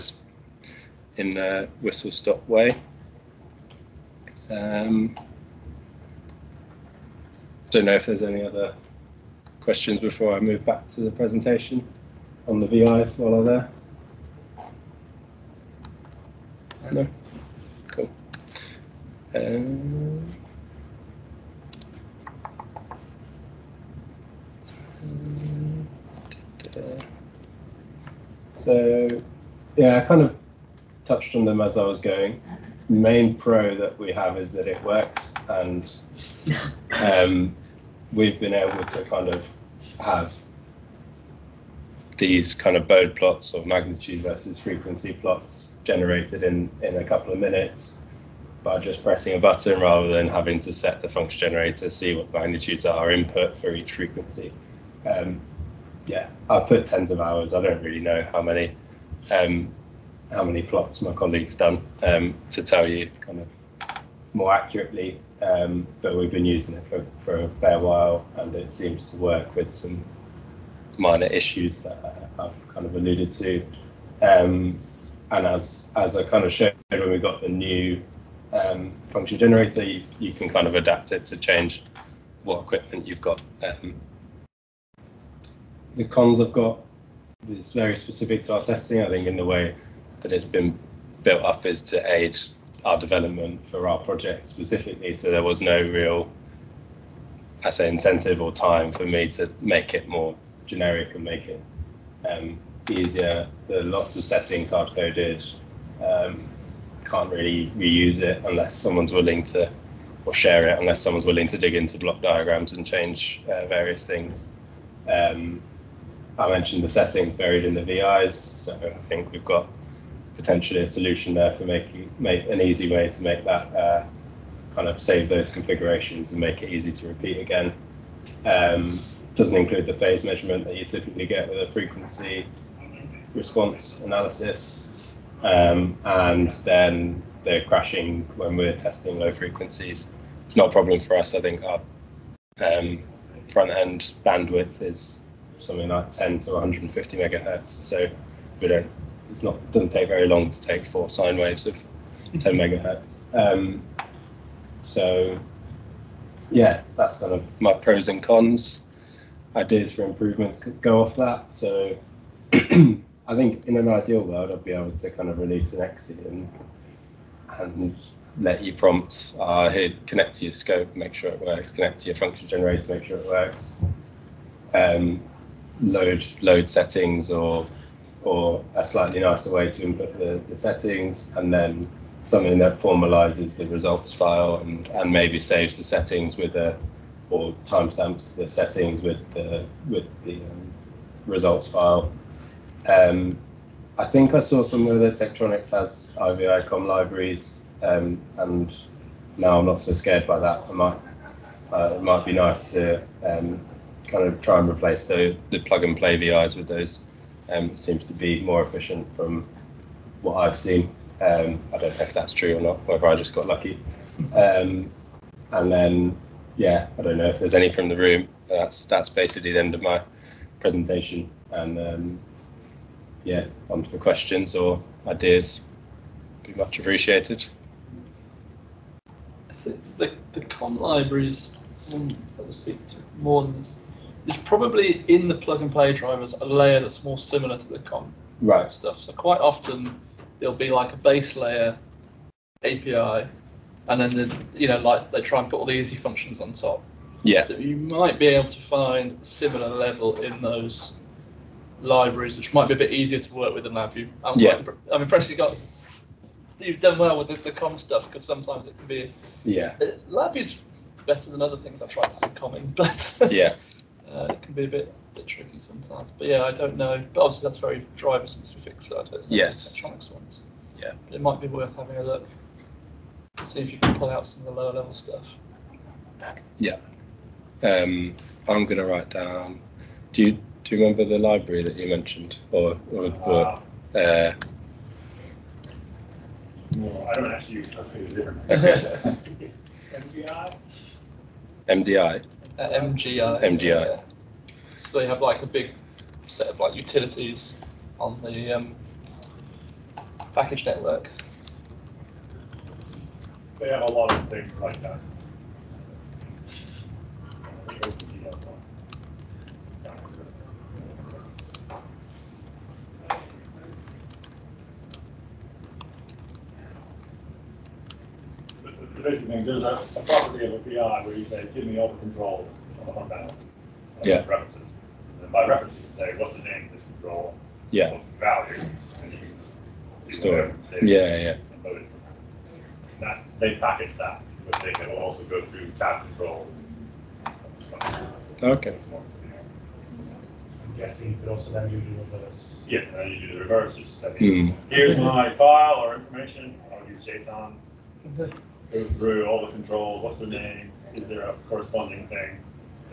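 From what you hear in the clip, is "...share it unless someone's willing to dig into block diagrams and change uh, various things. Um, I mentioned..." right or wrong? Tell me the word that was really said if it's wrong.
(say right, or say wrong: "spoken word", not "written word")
right.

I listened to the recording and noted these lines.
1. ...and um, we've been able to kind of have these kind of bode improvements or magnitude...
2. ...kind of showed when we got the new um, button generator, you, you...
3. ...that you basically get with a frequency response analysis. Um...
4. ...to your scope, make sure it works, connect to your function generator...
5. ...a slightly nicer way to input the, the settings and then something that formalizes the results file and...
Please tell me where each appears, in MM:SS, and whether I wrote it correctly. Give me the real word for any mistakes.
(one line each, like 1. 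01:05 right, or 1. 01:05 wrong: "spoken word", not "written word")
1. 00:35 wrong: "plots", not "improvements"
2. 01:16 wrong: "function", not "button"
3. 02:10 wrong: "typically", not "basically"
4. 02:50 right
5. 02:58 right.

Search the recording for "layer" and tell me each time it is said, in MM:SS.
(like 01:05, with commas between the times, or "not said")
03:56, 04:01.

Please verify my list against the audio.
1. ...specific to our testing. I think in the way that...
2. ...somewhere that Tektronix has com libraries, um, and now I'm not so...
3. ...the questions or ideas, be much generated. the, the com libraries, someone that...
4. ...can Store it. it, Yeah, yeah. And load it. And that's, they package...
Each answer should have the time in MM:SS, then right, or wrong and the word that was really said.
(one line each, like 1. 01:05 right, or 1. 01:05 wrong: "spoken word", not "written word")
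1. 01:27 right
2. 03:14 right
3. 03:43 wrong: "appreciated", not "generated"
4. 05:29 right.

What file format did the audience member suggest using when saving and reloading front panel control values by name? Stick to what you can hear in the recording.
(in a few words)
JSON.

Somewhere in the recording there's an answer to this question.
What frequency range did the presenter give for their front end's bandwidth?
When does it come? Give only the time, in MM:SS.
02:26.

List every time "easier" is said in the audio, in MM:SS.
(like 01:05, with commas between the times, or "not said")
01:42, 04:12.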